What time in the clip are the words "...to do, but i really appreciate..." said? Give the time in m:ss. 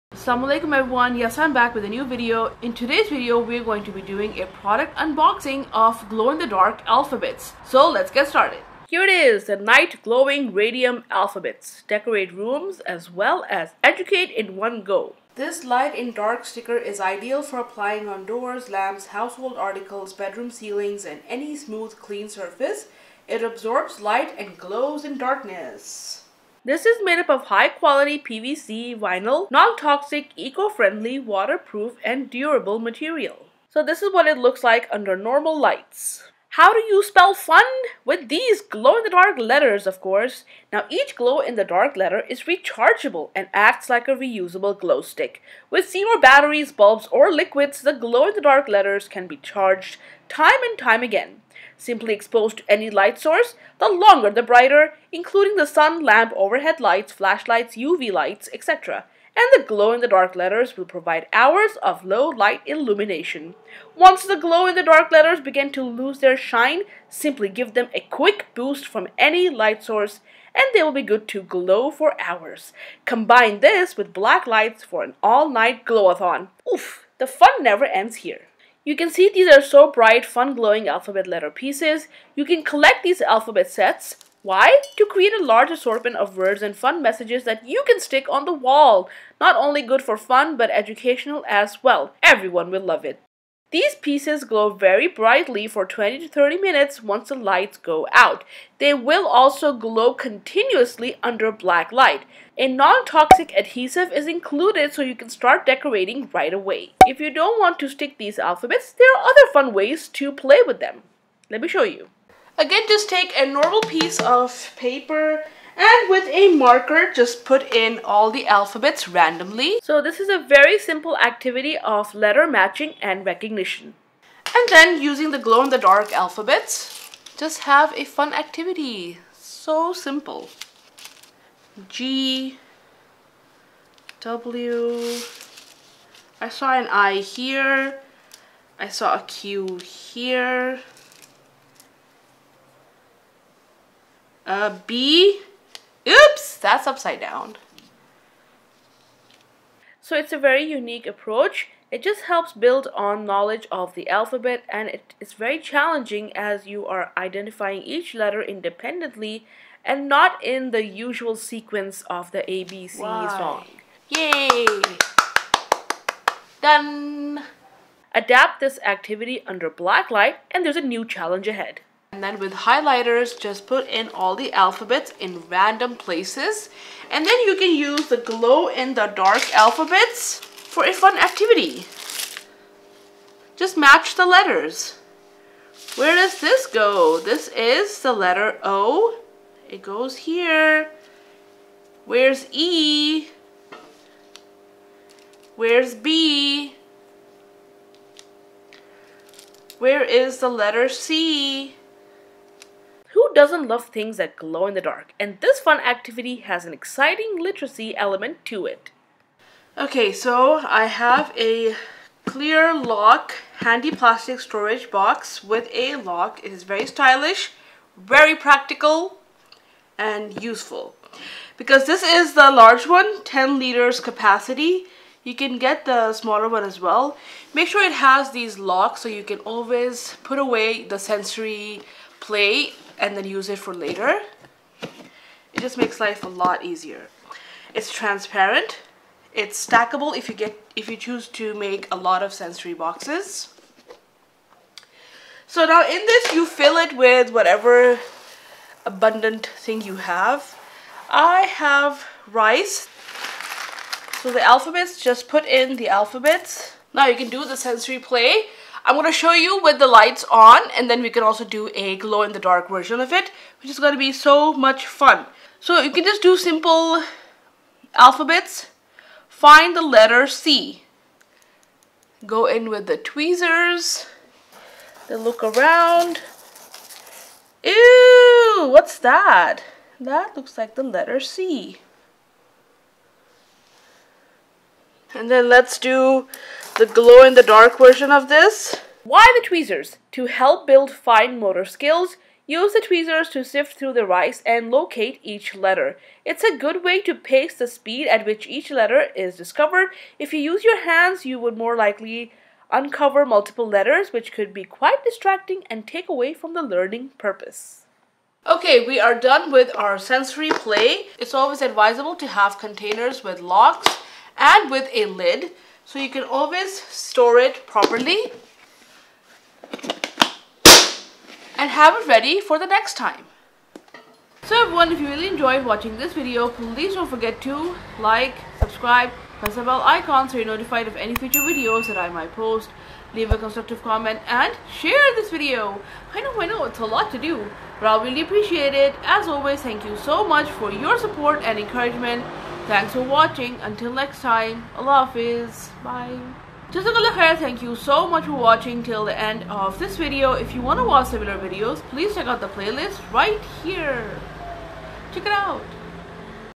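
5:37.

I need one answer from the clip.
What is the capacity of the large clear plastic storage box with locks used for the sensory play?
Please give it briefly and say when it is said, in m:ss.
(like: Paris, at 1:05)
10 liters, at 3:43.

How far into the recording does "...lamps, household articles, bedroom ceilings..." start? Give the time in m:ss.
0:18.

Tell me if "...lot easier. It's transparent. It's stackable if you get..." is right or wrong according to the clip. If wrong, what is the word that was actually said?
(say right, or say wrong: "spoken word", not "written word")
right.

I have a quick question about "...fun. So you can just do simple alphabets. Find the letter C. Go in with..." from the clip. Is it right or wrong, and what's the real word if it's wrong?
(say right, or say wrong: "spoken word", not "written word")
right.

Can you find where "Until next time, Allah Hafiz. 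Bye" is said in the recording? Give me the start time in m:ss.
5:43.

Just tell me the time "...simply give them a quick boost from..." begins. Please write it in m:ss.
1:07.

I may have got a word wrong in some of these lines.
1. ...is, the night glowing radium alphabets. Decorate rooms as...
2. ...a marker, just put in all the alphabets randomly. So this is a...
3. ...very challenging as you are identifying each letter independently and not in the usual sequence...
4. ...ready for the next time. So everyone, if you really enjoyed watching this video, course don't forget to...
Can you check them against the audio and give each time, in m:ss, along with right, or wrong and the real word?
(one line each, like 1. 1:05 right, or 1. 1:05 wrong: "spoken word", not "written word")
1. 0:09 right
2. 1:56 right
3. 2:35 right
4. 5:22 wrong: "please", not "course".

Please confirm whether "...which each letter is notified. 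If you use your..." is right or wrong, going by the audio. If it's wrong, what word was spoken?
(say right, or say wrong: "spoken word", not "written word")
wrong: "discovered", not "notified".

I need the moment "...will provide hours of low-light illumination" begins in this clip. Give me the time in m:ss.
1:00.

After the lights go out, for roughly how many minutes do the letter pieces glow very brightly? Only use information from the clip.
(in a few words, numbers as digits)
20 to 30 minutes.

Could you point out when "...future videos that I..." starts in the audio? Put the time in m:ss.
5:31.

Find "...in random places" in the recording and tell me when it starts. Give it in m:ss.
2:55.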